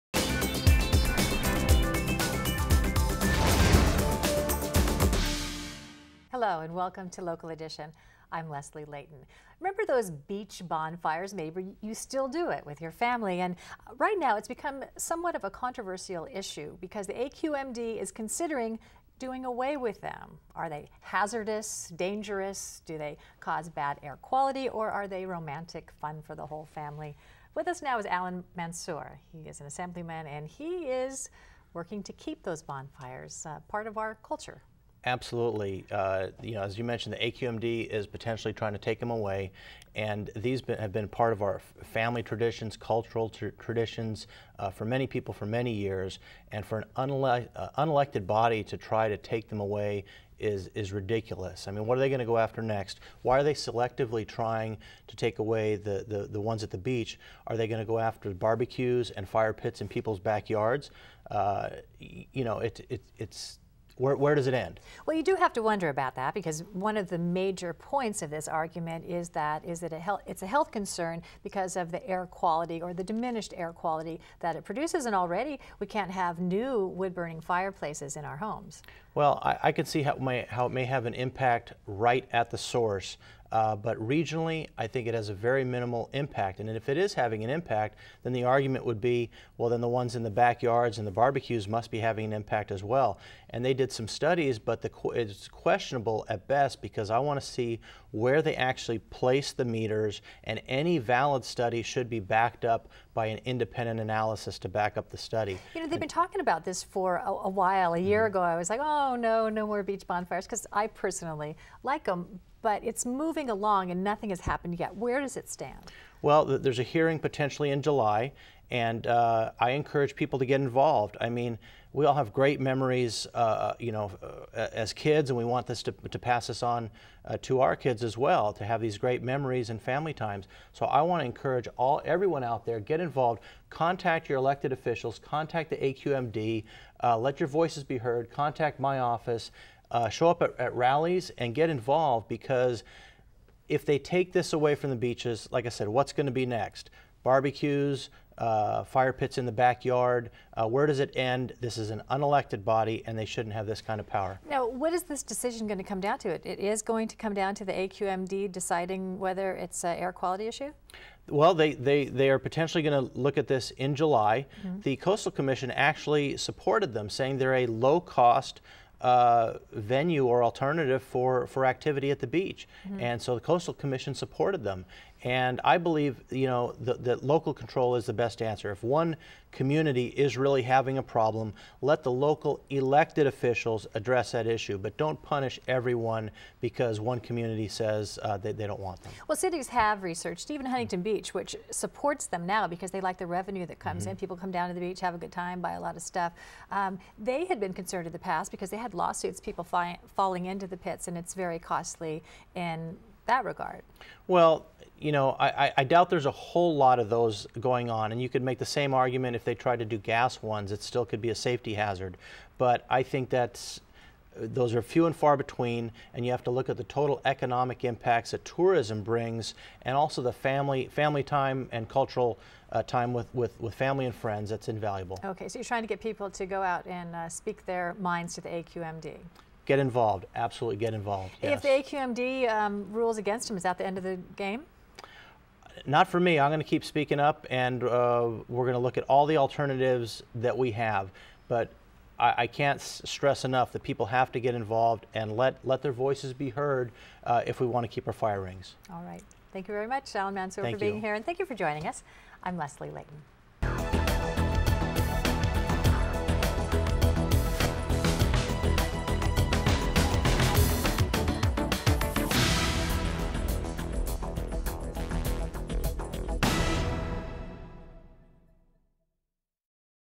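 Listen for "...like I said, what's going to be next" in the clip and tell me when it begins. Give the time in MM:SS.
02:25.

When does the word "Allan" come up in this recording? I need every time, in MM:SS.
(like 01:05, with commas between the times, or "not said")
00:28, 04:10.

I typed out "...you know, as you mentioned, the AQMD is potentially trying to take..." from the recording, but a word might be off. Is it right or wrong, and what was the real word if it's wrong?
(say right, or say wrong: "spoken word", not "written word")
right.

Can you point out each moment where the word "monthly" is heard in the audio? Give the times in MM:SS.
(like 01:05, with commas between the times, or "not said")
not said.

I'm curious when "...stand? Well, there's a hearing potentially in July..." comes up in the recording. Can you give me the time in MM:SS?
01:55.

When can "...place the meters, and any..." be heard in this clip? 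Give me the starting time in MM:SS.
01:38.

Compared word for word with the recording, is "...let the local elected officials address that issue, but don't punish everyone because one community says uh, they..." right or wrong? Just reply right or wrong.
right.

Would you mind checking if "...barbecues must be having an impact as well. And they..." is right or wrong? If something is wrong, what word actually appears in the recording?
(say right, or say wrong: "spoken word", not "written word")
right.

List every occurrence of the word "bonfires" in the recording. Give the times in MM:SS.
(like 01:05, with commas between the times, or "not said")
00:10, 00:32, 01:50.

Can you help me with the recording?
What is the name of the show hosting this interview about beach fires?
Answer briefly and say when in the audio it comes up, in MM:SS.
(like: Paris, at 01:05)
Local Edition, at 00:07.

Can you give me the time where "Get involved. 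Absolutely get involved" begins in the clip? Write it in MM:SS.
03:49.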